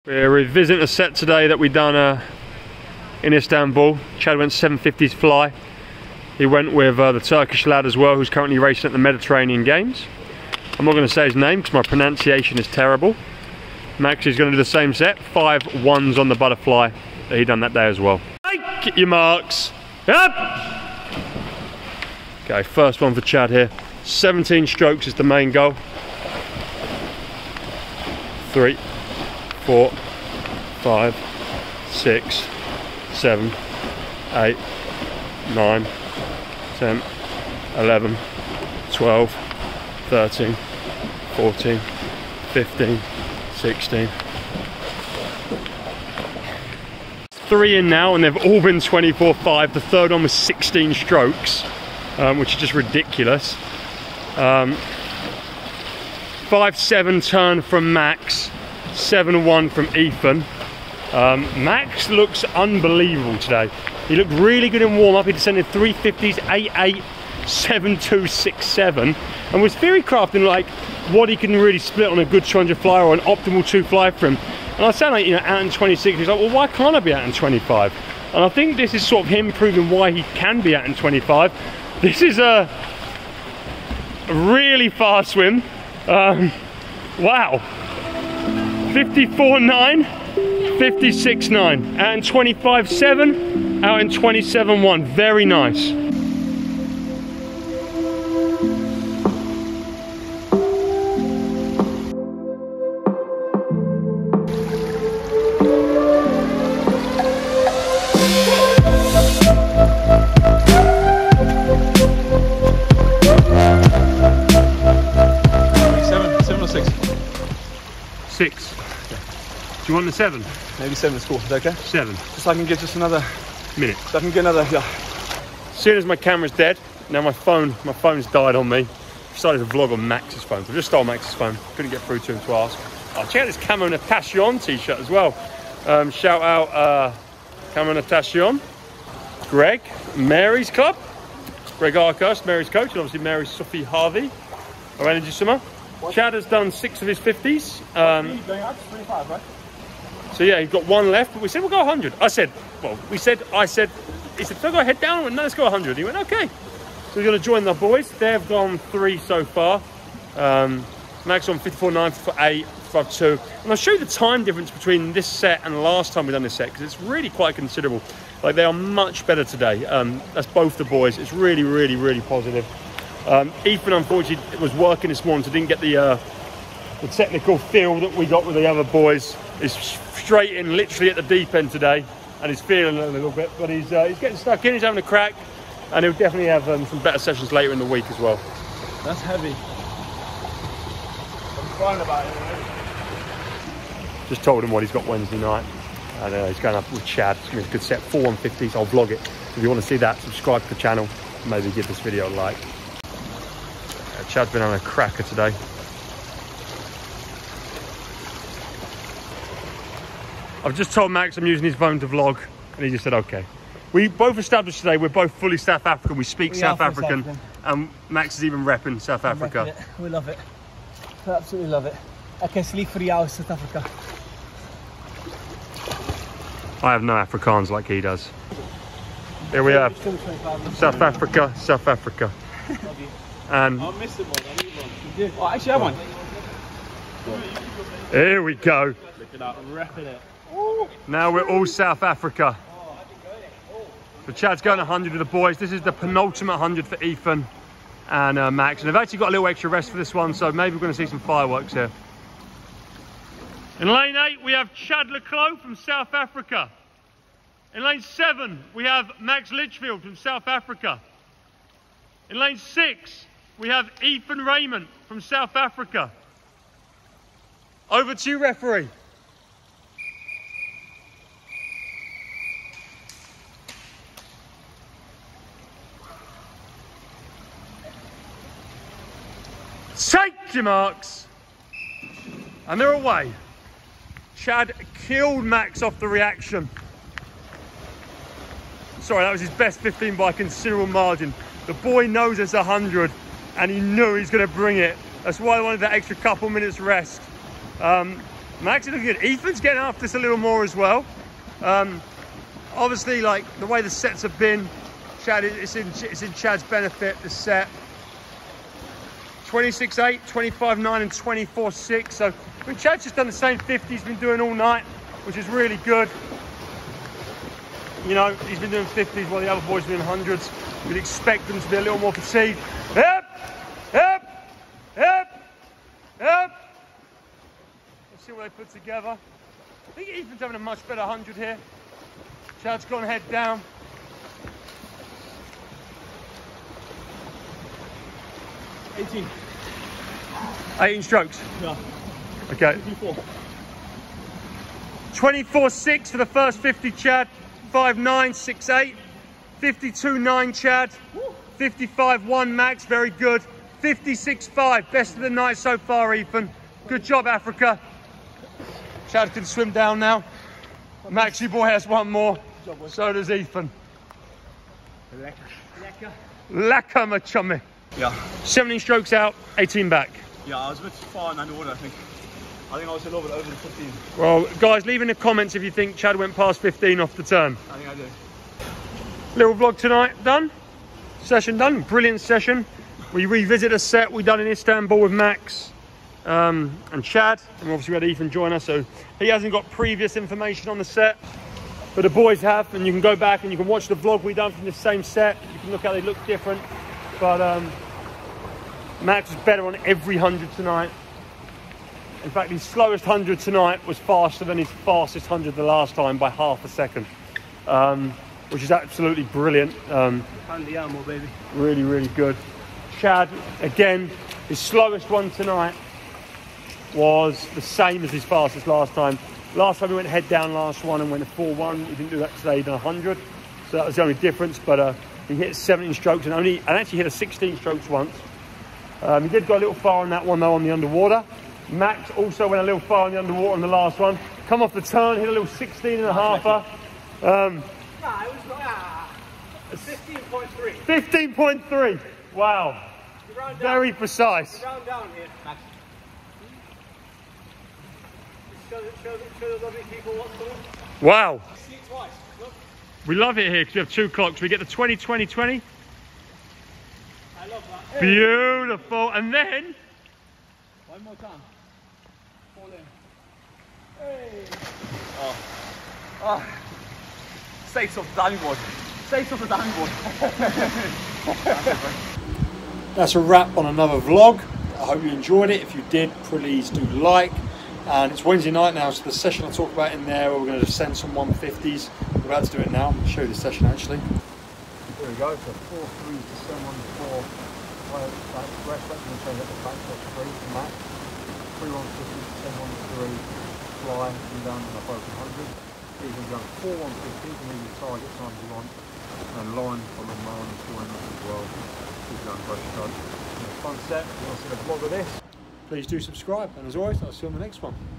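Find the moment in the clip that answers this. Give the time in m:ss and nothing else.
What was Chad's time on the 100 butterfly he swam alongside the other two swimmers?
5:49.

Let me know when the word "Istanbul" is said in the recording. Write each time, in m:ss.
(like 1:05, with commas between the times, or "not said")
0:03, 6:24.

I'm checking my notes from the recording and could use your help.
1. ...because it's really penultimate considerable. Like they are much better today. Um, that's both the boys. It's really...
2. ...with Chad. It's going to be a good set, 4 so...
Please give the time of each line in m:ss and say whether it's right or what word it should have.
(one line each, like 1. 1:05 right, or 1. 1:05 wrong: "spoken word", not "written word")
1. 2:46 wrong: "quite", not "penultimate"
2. 3:16 right.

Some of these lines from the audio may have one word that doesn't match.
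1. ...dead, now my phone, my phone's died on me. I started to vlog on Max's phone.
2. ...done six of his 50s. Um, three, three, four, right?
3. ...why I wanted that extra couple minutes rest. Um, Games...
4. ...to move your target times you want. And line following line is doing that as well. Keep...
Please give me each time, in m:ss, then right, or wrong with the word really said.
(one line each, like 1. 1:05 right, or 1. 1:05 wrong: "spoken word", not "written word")
1. 2:06 right
2. 2:26 wrong: "five", not "four"
3. 4:55 wrong: "Max", not "Games"
4. 8:17 right.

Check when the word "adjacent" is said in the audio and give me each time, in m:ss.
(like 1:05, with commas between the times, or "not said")
not said.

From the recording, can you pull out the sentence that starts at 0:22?
Okay, first one for Chad here.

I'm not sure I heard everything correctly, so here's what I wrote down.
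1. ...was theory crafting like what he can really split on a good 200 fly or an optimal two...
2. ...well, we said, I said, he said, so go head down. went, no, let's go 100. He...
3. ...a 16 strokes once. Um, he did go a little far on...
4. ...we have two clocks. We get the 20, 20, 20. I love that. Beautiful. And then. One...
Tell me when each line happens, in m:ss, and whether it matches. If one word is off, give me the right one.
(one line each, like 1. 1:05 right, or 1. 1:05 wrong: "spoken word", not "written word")
1. 1:09 right
2. 2:32 right
3. 7:07 right
4. 7:33 right.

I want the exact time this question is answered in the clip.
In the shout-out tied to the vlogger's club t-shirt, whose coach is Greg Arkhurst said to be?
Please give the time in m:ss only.
2:23.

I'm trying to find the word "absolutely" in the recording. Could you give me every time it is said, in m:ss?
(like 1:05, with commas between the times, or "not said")
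3:41, 6:48.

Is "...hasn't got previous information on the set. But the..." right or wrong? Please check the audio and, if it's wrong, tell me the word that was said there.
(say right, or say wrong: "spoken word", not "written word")
right.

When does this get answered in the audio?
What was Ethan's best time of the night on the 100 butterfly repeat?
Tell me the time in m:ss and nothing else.
5:53.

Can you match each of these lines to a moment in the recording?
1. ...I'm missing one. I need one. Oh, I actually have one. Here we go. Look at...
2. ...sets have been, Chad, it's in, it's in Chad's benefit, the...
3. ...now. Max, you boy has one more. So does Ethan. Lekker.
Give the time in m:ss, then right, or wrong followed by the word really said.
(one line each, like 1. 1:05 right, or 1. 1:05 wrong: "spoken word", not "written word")
1. 3:53 right
2. 5:03 right
3. 5:59 right.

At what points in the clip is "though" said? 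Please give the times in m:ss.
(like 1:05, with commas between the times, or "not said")
7:10.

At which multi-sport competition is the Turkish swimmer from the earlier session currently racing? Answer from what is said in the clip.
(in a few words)
Mediterranean Games.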